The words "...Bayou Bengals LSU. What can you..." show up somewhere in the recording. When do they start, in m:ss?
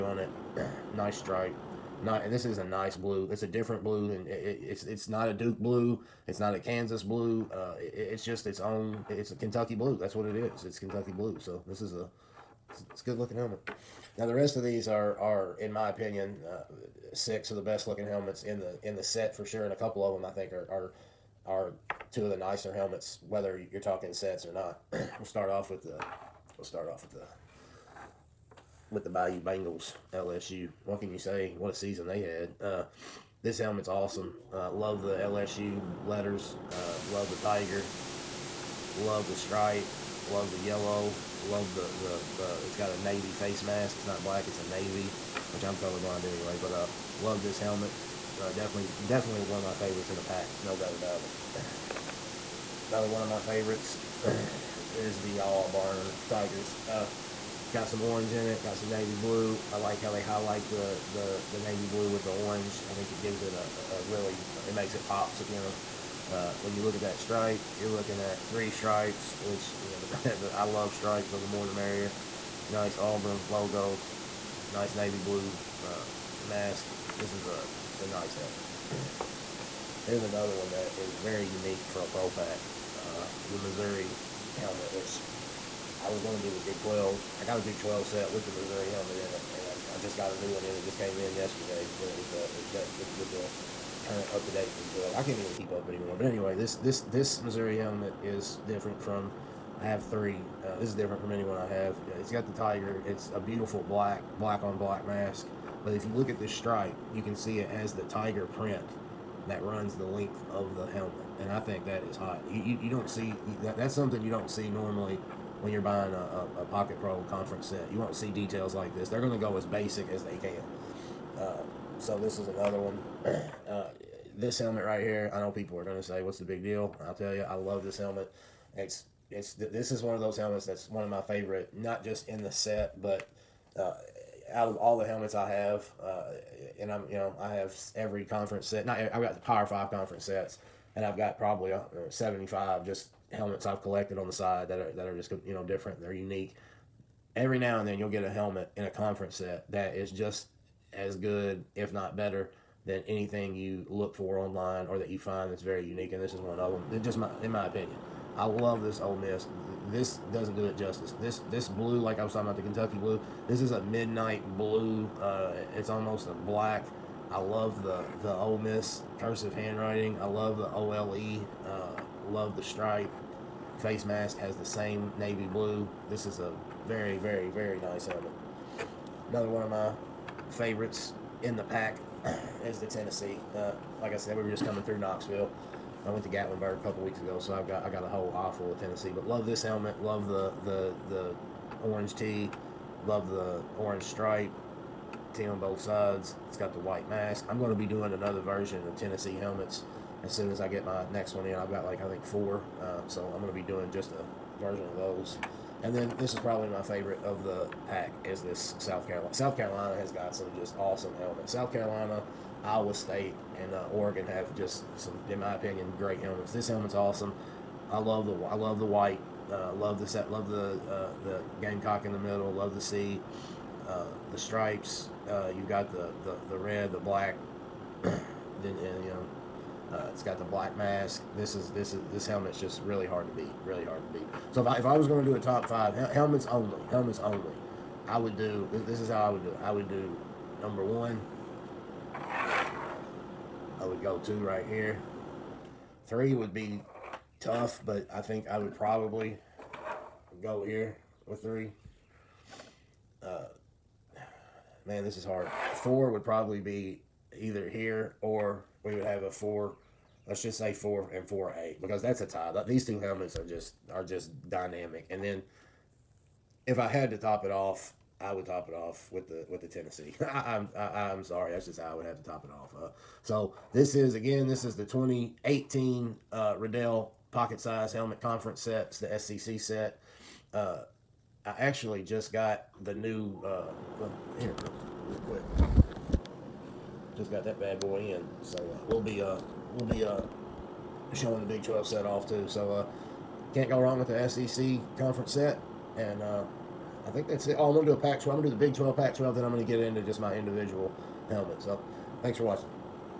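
0:29.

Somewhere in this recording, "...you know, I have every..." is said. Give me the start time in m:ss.
2:17.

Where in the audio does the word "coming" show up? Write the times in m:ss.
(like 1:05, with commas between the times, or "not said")
3:04.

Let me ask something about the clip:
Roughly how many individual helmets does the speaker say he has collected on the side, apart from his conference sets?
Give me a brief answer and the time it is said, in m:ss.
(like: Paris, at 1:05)
75, at 2:22.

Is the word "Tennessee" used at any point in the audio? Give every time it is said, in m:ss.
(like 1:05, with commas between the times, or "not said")
3:02, 3:08, 3:19, 4:29.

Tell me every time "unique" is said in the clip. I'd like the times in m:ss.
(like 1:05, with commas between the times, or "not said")
1:21, 2:26, 2:35.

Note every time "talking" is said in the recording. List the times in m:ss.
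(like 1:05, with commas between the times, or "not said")
0:23, 2:42.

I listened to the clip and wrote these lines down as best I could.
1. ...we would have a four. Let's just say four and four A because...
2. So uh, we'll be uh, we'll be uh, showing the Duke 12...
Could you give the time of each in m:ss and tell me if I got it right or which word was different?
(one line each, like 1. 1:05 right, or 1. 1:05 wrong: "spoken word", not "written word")
1. 4:18 right
2. 4:48 wrong: "Big", not "Duke".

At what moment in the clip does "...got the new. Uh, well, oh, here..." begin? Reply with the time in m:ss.
4:42.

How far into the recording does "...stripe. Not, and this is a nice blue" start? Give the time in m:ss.
0:01.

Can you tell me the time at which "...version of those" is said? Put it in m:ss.
3:24.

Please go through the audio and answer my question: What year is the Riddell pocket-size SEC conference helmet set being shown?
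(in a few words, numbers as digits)
2018.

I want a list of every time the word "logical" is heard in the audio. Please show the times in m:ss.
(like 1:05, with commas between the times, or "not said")
not said.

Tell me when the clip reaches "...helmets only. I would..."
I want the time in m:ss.
3:56.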